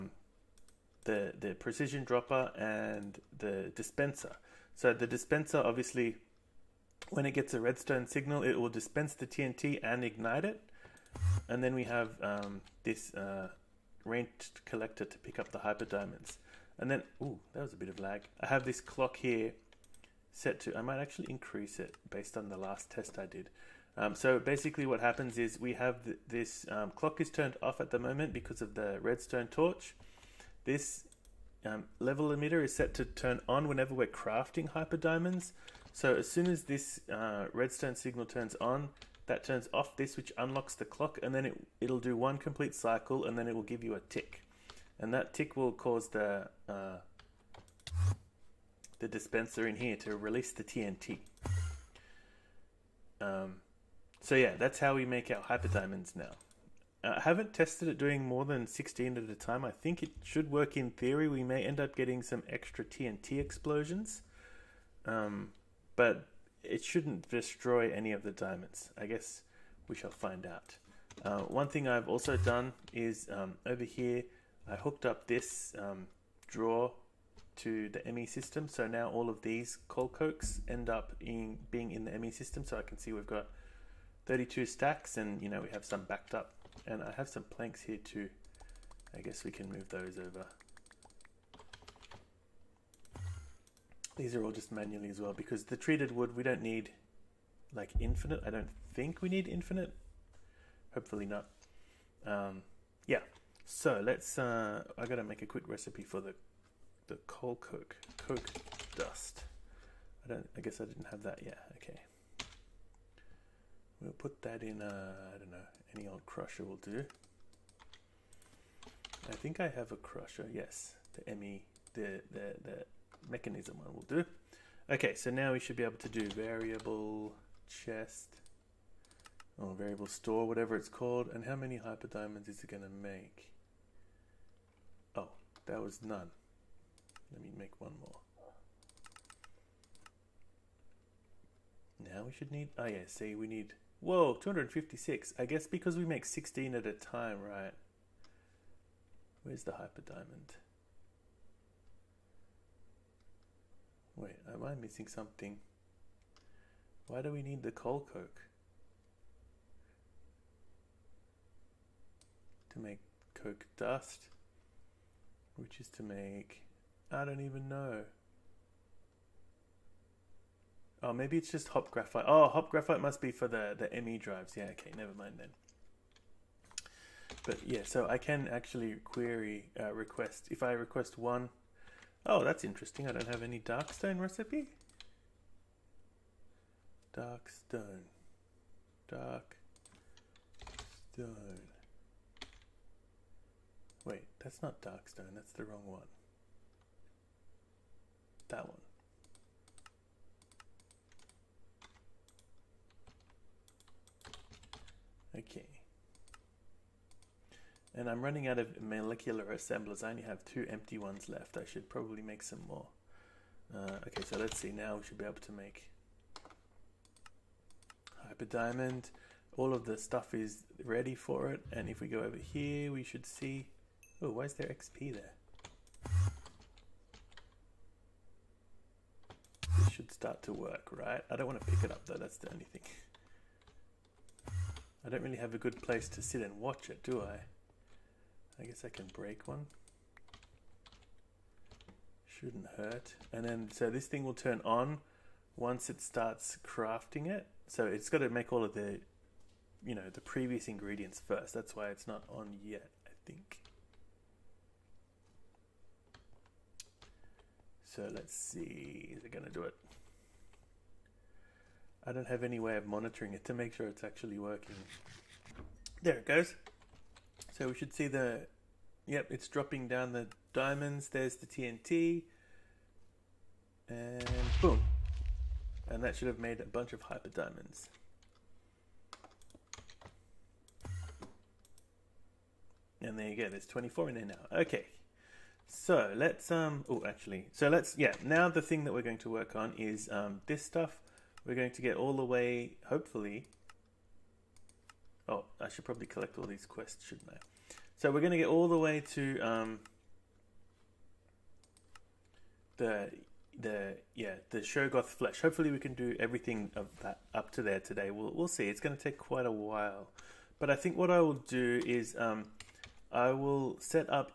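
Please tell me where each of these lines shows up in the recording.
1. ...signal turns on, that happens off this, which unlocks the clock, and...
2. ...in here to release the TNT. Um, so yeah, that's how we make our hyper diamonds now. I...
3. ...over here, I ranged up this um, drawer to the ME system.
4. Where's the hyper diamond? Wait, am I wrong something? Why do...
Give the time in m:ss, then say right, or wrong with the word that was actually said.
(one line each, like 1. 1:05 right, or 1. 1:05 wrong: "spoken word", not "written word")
1. 0:37 wrong: "turns", not "happens"
2. 0:49 right
3. 1:13 wrong: "hooked", not "ranged"
4. 2:29 wrong: "missing", not "wrong".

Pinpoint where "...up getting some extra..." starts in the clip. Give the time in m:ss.
1:01.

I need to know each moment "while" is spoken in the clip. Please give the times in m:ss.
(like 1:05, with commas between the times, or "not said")
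5:09.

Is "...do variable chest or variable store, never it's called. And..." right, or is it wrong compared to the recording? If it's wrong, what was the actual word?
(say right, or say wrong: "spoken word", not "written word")
wrong: "whatever", not "never".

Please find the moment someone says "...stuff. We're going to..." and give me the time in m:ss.
4:50.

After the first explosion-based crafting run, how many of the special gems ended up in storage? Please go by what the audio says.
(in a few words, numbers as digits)
24.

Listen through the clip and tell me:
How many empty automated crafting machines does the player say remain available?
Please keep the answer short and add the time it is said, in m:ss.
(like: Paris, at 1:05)
two, at 3:30.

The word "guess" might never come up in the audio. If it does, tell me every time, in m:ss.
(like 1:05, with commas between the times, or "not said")
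1:09, 1:29, 1:50, 2:25, 3:58.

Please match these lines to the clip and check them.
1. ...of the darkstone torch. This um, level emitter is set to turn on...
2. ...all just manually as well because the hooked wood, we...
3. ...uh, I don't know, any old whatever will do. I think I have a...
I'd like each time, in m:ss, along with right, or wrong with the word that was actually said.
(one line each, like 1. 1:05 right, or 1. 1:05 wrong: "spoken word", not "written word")
1. 0:28 wrong: "redstone", not "darkstone"
2. 1:34 wrong: "treated", not "hooked"
3. 1:54 wrong: "crusher", not "whatever".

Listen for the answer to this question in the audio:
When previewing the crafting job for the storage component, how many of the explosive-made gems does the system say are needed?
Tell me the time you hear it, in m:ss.
2:24.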